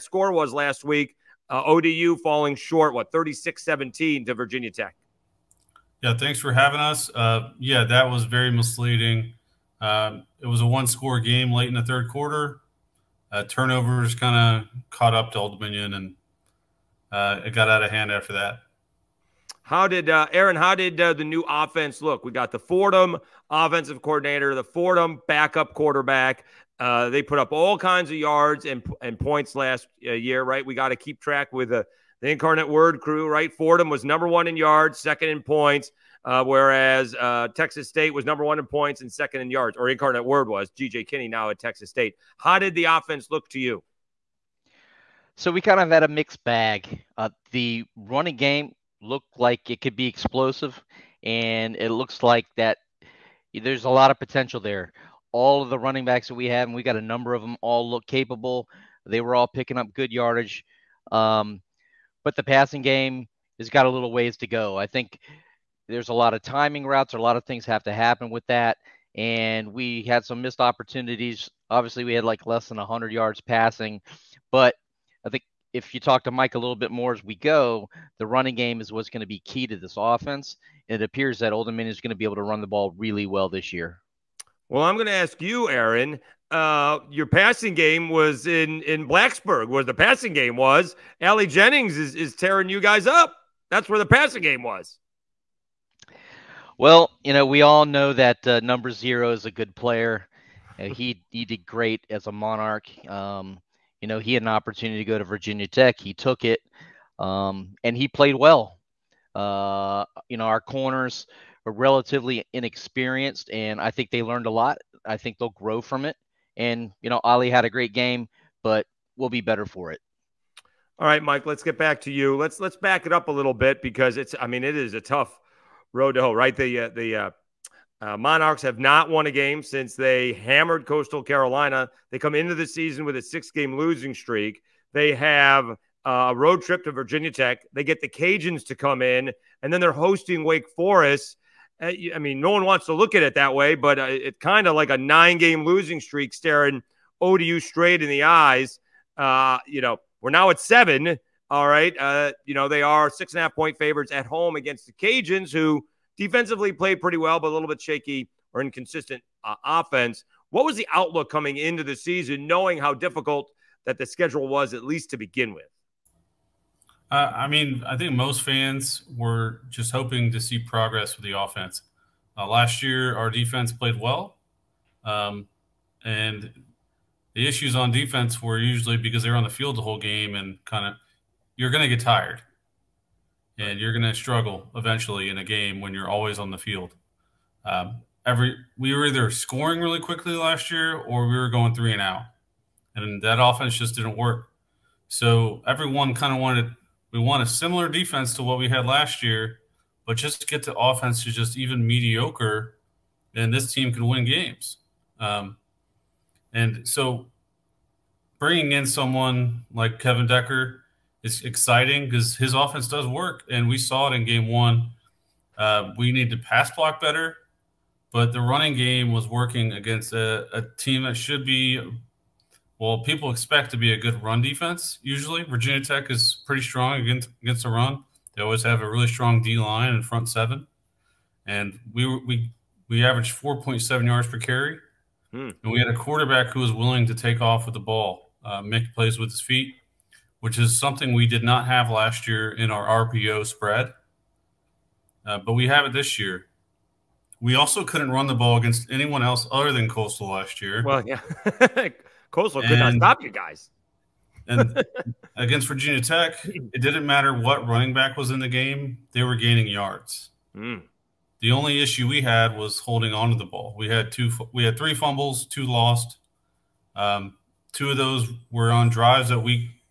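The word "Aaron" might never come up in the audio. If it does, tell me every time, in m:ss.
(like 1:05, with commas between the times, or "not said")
0:20, 1:25.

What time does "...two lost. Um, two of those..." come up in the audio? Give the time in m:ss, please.
4:25.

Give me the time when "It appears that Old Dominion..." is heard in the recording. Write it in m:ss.
1:20.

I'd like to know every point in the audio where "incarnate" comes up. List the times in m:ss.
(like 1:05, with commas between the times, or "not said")
0:32, 0:39.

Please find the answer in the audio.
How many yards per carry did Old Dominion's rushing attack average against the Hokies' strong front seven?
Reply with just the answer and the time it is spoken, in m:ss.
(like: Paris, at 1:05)
4.7, at 3:53.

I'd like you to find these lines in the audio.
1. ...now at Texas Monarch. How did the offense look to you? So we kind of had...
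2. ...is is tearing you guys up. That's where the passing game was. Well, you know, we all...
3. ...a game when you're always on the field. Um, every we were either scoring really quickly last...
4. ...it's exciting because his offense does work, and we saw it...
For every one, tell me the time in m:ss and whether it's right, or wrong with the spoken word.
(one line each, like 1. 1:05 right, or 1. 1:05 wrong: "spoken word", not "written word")
1. 0:41 wrong: "State", not "Monarch"
2. 1:31 right
3. 3:05 right
4. 3:31 right.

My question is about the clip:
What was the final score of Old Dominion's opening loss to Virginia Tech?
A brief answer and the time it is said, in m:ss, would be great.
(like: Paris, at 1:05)
36-17, at 0:03.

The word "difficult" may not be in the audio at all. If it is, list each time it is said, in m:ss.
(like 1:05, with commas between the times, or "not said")
2:42.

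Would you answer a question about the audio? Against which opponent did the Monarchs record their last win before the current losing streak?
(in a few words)
Coastal Carolina.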